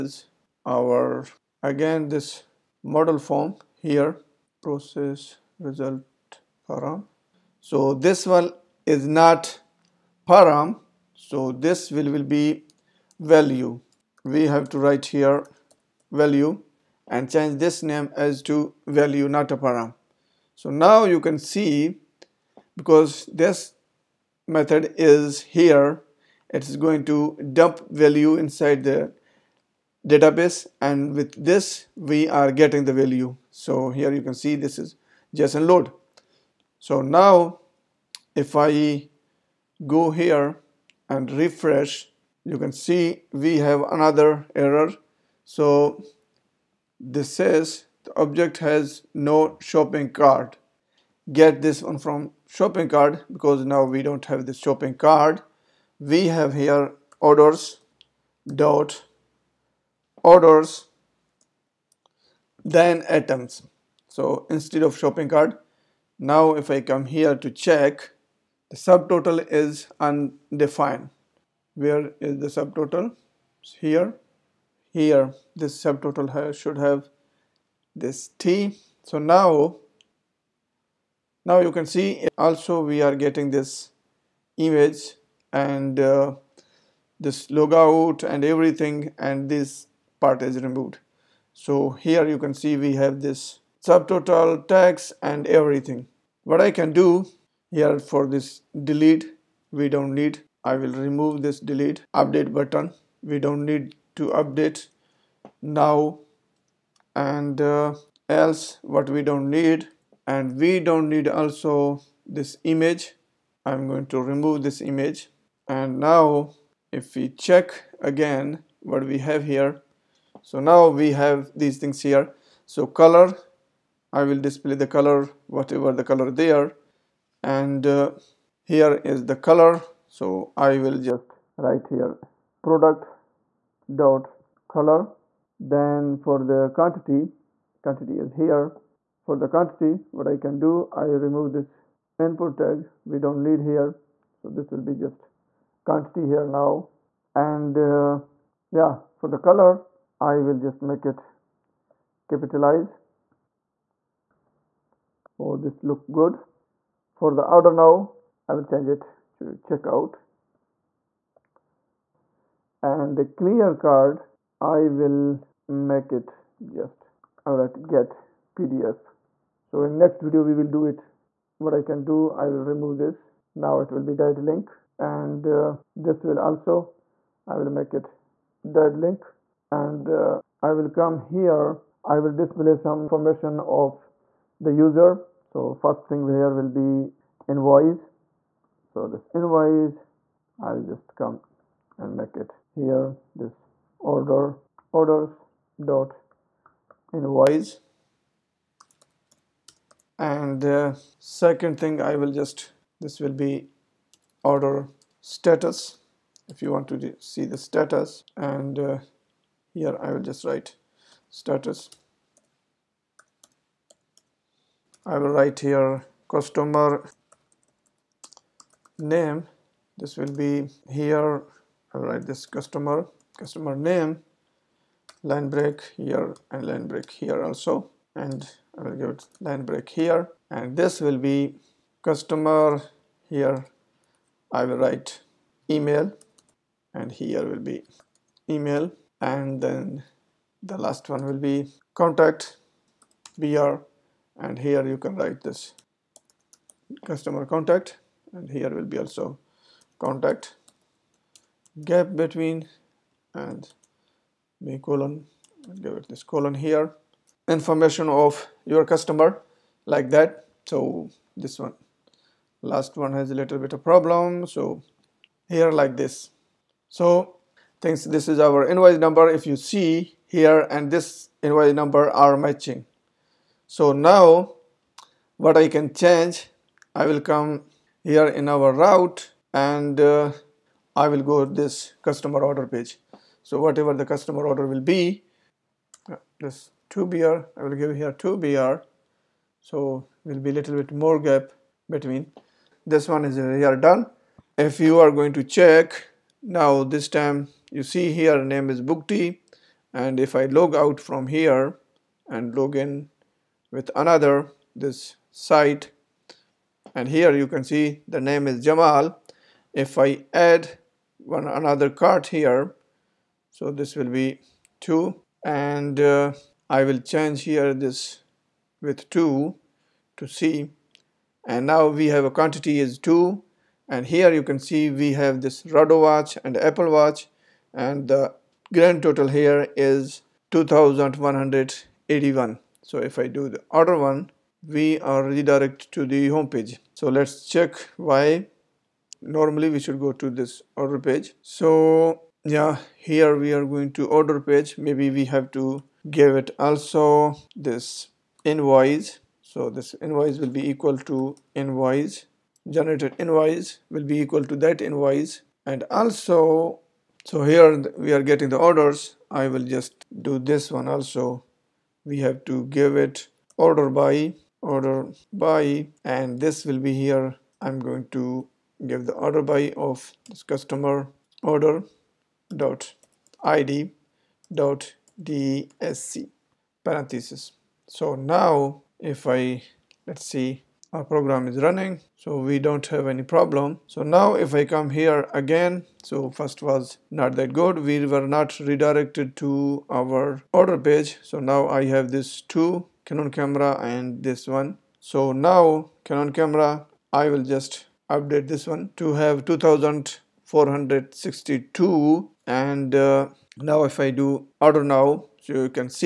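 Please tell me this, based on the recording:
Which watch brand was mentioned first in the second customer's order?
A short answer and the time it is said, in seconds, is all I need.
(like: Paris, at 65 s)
Rado, at 325 s.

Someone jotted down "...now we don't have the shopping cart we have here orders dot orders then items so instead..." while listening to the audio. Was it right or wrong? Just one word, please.
right.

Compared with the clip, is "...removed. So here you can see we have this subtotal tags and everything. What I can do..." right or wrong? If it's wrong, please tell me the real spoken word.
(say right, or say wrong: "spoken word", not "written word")
right.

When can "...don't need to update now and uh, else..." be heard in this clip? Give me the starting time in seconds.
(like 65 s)
103 s.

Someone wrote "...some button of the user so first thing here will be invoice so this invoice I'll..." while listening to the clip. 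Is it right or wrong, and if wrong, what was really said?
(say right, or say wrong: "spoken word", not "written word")
wrong: "information", not "button".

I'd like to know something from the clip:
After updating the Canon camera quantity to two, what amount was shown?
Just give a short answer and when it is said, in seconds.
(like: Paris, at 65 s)
2462, at 399 s.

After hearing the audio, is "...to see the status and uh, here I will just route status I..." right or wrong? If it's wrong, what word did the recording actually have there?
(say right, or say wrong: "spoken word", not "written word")
wrong: "write", not "route".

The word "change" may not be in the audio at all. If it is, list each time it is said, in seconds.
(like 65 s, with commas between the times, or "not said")
17 s, 158 s, 275 s, 317 s.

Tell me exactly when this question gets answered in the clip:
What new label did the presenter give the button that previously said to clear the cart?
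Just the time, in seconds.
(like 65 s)
167 s.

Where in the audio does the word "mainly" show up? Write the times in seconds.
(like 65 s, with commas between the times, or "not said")
not said.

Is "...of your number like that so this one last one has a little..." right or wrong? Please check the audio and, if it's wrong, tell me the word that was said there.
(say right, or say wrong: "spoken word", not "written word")
wrong: "customer", not "number".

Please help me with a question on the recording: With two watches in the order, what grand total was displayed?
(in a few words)
2181.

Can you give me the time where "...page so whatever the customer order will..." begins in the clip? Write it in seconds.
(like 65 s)
282 s.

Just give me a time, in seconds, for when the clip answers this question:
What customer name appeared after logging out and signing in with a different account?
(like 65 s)
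308 s.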